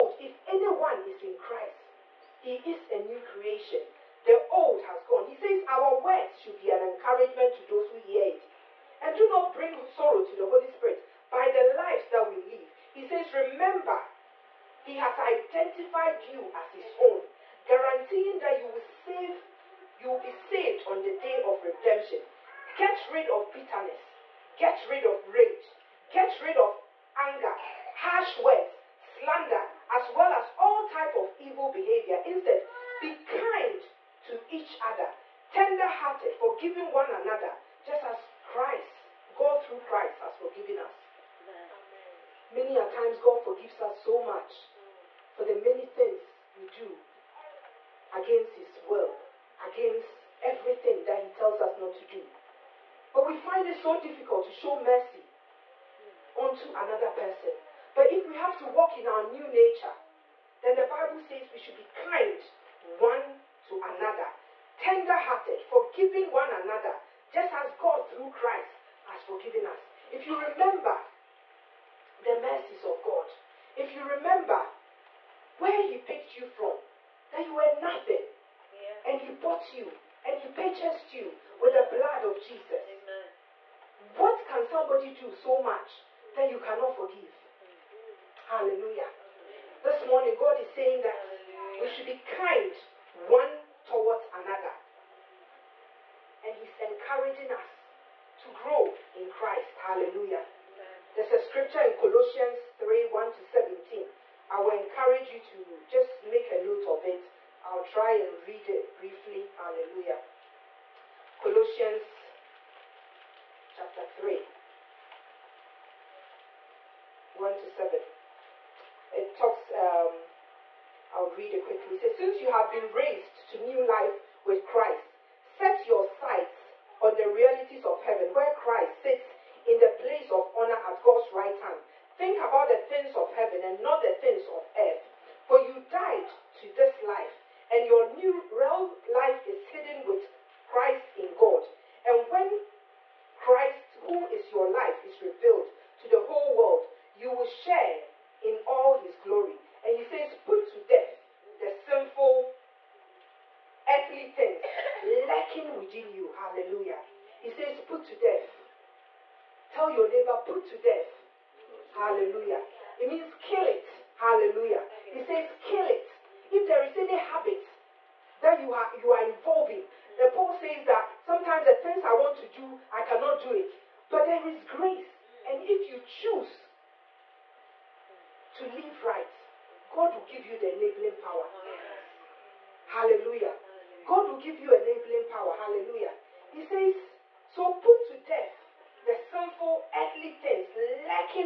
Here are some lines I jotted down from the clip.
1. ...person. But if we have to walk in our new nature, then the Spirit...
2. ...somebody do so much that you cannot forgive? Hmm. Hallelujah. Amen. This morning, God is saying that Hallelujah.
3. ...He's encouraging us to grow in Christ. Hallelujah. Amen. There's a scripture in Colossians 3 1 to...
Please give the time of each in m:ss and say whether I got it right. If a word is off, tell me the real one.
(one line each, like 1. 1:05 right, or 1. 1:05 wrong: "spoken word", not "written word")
1. 0:57 wrong: "Bible", not "Spirit"
2. 1:24 right
3. 1:36 right.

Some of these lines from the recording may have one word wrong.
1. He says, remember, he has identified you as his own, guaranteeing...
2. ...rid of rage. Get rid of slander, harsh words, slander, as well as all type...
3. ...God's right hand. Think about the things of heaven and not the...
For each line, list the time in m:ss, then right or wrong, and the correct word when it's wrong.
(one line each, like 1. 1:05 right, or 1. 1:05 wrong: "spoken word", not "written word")
1. 0:12 right
2. 0:24 wrong: "anger", not "slander"
3. 2:11 right.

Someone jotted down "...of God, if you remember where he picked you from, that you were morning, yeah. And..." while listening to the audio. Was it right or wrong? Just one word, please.
wrong.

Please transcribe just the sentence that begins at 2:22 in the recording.
And when Christ, who is your life, is revealed to the whole world, you will share in all his glory.